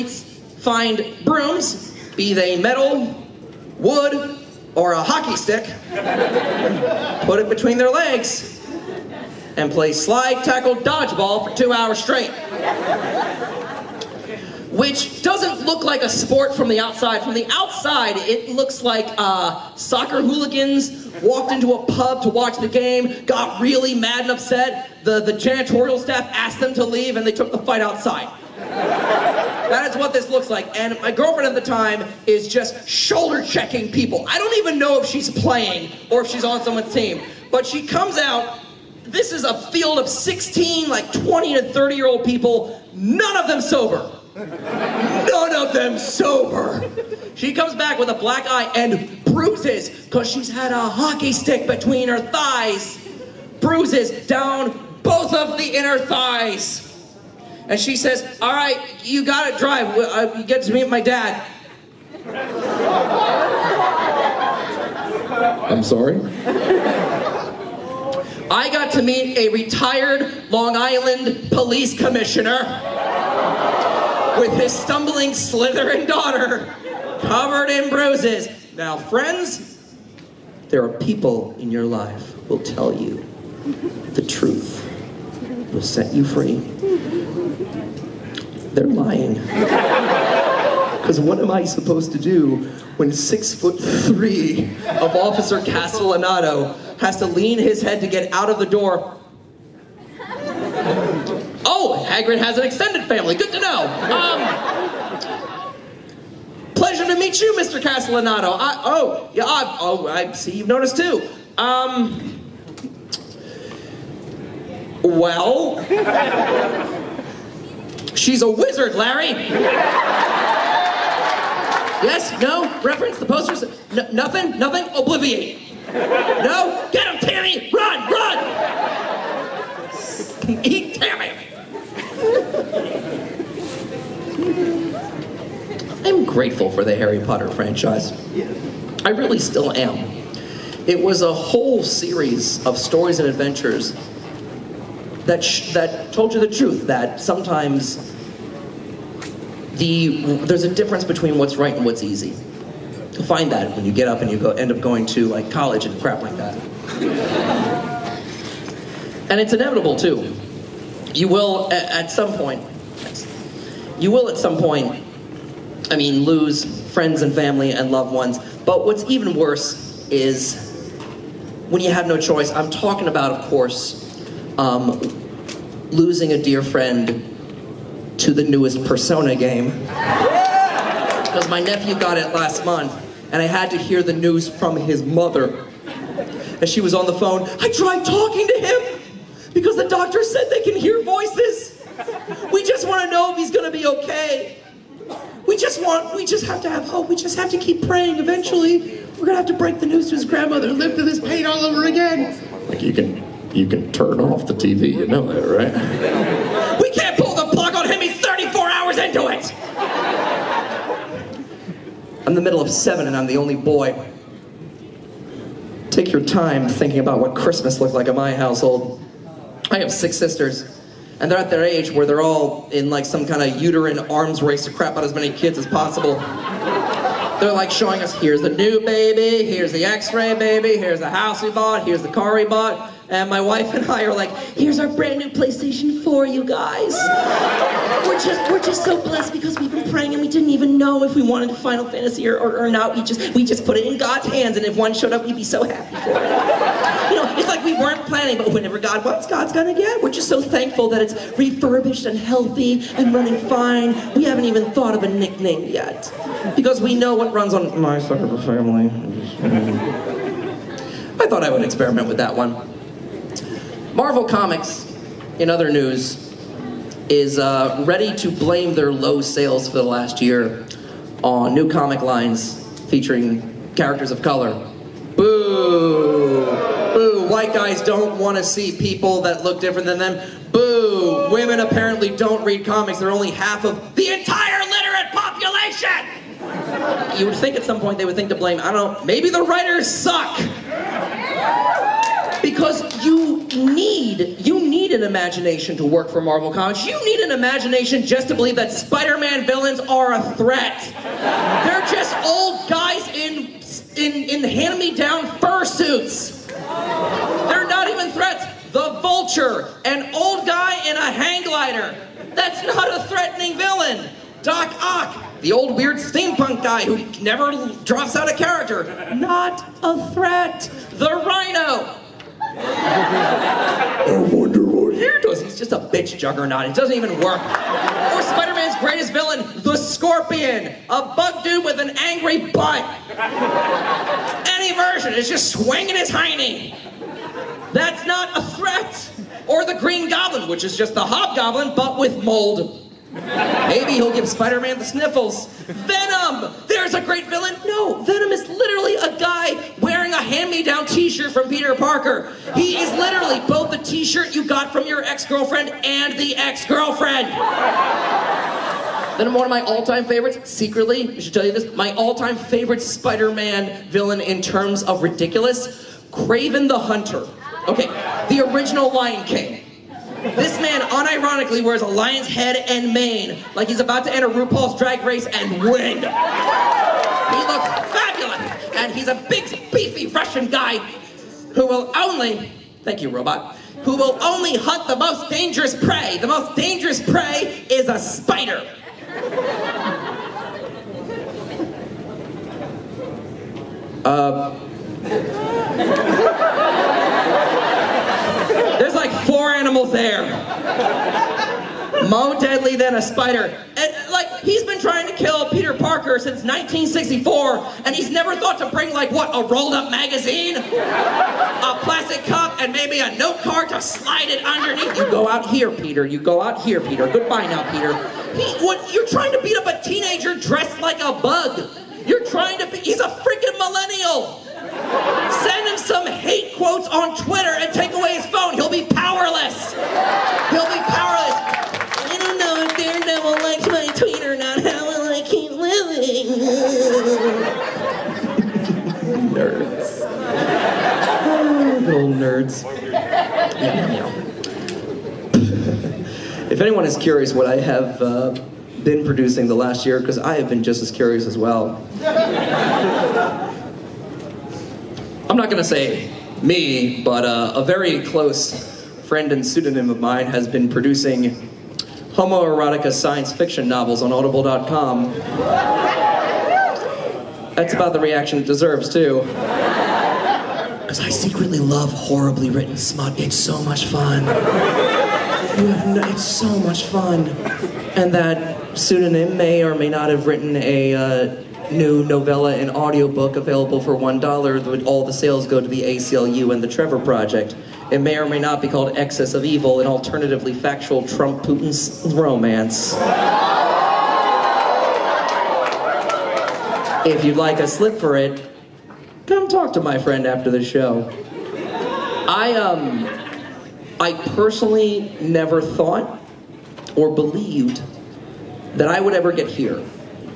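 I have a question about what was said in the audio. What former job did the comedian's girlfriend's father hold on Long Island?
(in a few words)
police commissioner.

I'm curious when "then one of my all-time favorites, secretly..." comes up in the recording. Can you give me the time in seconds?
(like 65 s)
359 s.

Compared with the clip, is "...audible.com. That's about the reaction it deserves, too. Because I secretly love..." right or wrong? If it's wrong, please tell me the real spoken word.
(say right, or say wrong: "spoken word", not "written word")
right.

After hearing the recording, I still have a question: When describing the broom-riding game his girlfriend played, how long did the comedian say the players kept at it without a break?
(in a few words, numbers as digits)
2 hours.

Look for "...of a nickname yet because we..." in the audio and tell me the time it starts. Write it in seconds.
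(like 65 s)
254 s.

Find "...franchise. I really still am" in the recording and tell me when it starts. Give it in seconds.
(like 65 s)
137 s.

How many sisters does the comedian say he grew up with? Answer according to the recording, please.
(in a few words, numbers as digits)
6.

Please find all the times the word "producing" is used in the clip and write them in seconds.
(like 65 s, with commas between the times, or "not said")
449 s, 460 s.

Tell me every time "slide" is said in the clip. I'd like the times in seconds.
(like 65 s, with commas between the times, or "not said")
9 s, 413 s.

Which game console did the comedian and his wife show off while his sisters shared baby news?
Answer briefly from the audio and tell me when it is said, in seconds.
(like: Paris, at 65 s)
PlayStation 4, at 235 s.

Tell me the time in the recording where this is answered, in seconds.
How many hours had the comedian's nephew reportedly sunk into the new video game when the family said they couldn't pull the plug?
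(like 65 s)
208 s.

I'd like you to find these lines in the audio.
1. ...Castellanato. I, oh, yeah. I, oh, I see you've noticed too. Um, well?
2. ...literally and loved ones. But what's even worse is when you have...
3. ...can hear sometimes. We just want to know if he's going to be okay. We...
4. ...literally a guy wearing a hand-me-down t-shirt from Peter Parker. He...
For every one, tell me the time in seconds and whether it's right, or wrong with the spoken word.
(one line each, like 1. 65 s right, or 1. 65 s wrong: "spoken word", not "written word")
1. 107 s right
2. 167 s wrong: "family", not "literally"
3. 190 s wrong: "voices", not "sometimes"
4. 348 s right.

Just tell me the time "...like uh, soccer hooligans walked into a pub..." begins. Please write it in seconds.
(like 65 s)
18 s.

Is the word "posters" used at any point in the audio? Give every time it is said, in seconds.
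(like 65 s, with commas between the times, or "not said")
123 s.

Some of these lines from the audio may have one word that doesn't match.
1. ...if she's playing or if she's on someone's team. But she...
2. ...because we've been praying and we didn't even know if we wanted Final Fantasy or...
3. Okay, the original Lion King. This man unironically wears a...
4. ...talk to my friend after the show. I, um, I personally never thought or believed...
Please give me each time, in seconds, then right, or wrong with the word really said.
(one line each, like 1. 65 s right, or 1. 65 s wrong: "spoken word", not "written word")
1. 35 s right
2. 239 s right
3. 367 s right
4. 499 s right.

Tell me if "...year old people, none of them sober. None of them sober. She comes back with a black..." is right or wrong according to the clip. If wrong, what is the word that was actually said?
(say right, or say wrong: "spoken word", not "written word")
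right.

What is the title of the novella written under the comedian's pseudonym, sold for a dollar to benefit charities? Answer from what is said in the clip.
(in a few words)
Excess of Evil.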